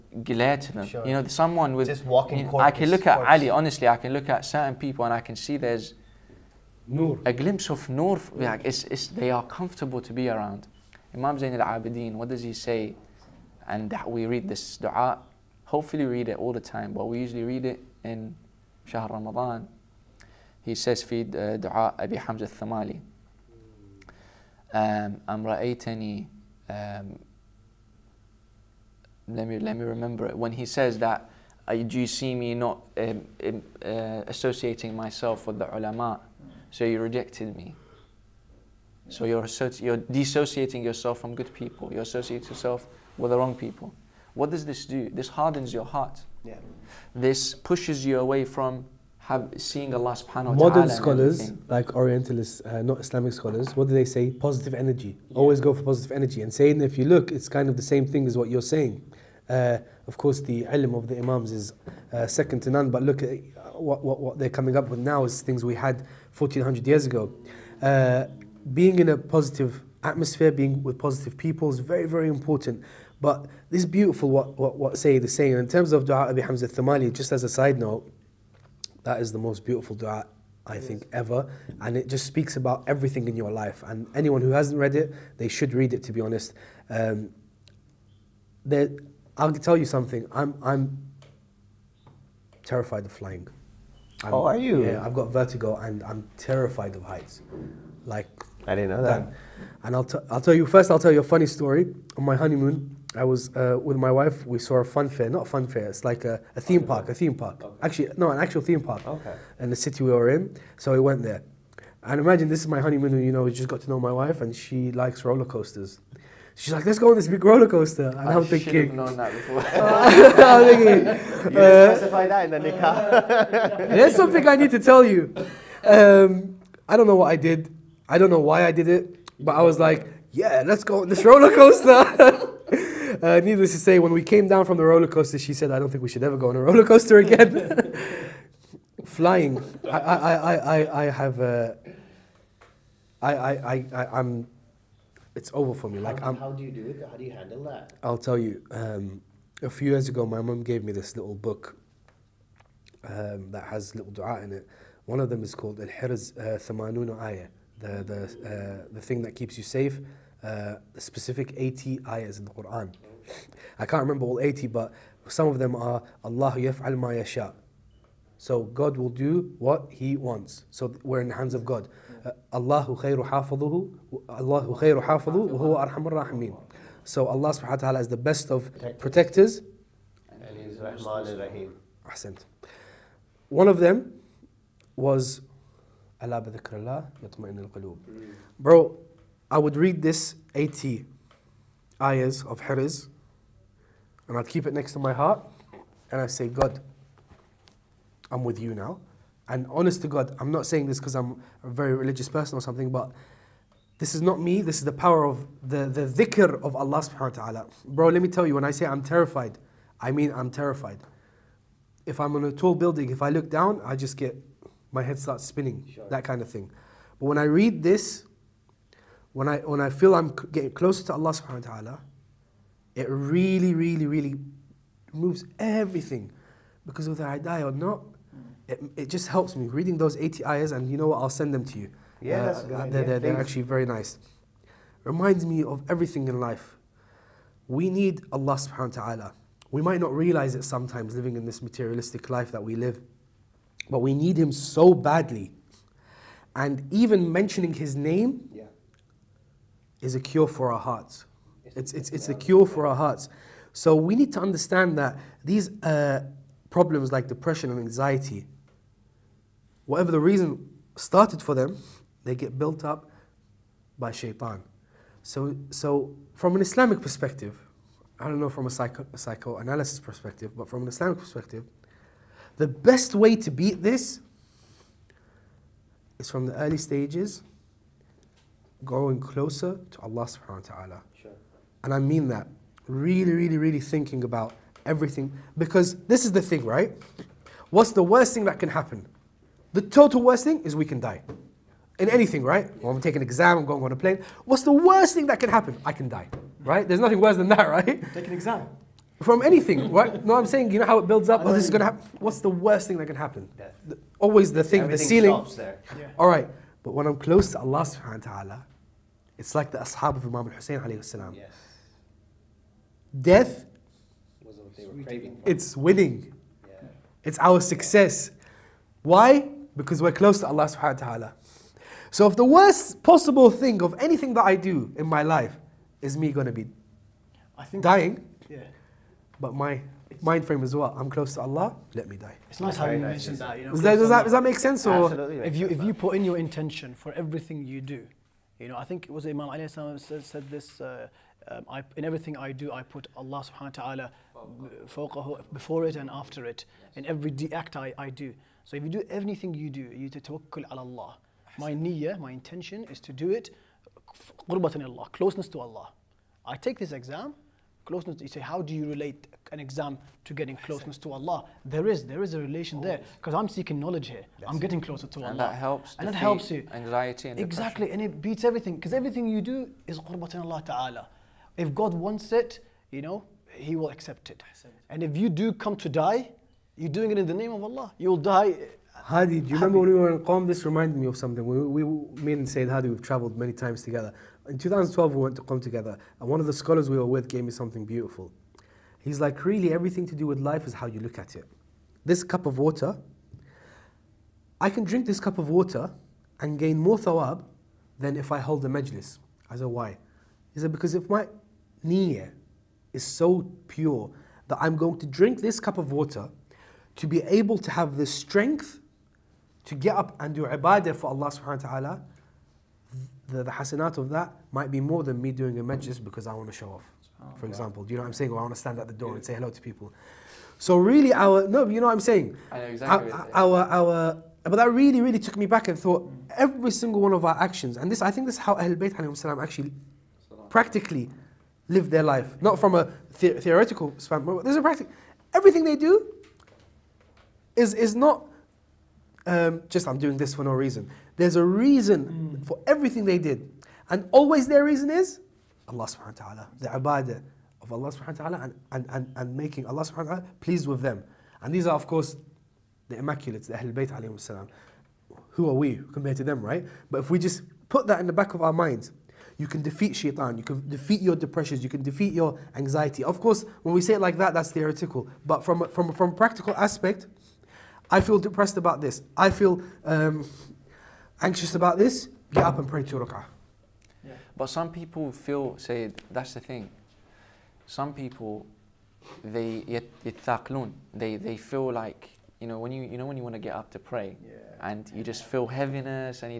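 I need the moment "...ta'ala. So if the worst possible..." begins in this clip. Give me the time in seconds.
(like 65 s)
321 s.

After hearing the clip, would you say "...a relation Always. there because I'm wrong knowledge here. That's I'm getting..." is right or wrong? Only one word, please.
wrong.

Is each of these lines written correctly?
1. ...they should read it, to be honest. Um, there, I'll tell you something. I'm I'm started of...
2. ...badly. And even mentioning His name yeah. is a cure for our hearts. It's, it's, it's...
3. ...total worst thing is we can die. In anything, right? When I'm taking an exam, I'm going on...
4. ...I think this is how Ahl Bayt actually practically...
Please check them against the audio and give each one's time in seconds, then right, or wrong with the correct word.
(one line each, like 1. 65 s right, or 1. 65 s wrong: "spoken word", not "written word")
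1. 85 s wrong: "terrified", not "started"
2. 244 s right
3. 289 s right
4. 428 s right.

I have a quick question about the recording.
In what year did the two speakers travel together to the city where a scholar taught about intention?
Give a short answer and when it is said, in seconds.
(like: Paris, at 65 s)
2012, at 384 s.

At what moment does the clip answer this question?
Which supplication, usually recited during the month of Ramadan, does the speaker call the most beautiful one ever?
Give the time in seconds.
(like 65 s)
21 s.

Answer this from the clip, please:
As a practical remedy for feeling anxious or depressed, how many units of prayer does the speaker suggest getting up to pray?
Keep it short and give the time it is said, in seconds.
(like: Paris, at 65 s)
2, at 472 s.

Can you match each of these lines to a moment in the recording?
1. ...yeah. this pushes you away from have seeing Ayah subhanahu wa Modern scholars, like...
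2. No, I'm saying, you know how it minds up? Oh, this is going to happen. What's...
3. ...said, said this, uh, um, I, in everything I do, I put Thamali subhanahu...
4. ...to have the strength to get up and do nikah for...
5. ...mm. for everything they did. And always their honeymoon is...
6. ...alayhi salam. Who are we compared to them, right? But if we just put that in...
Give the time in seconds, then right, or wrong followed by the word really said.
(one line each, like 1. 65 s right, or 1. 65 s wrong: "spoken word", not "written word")
1. 46 s wrong: "Allah", not "Ayah"
2. 300 s wrong: "builds", not "minds"
3. 339 s wrong: "Allah", not "Thamali"
4. 407 s wrong: "ibadah", not "nikah"
5. 442 s wrong: "reason", not "honeymoon"
6. 453 s right.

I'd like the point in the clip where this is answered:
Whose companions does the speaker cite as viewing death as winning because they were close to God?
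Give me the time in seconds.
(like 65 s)
310 s.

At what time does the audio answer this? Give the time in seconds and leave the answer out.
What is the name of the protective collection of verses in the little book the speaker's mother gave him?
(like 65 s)
155 s.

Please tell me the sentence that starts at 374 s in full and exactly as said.
And if you do come to die, you're doing it in the name of Allah.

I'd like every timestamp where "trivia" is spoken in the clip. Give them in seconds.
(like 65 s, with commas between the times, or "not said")
not said.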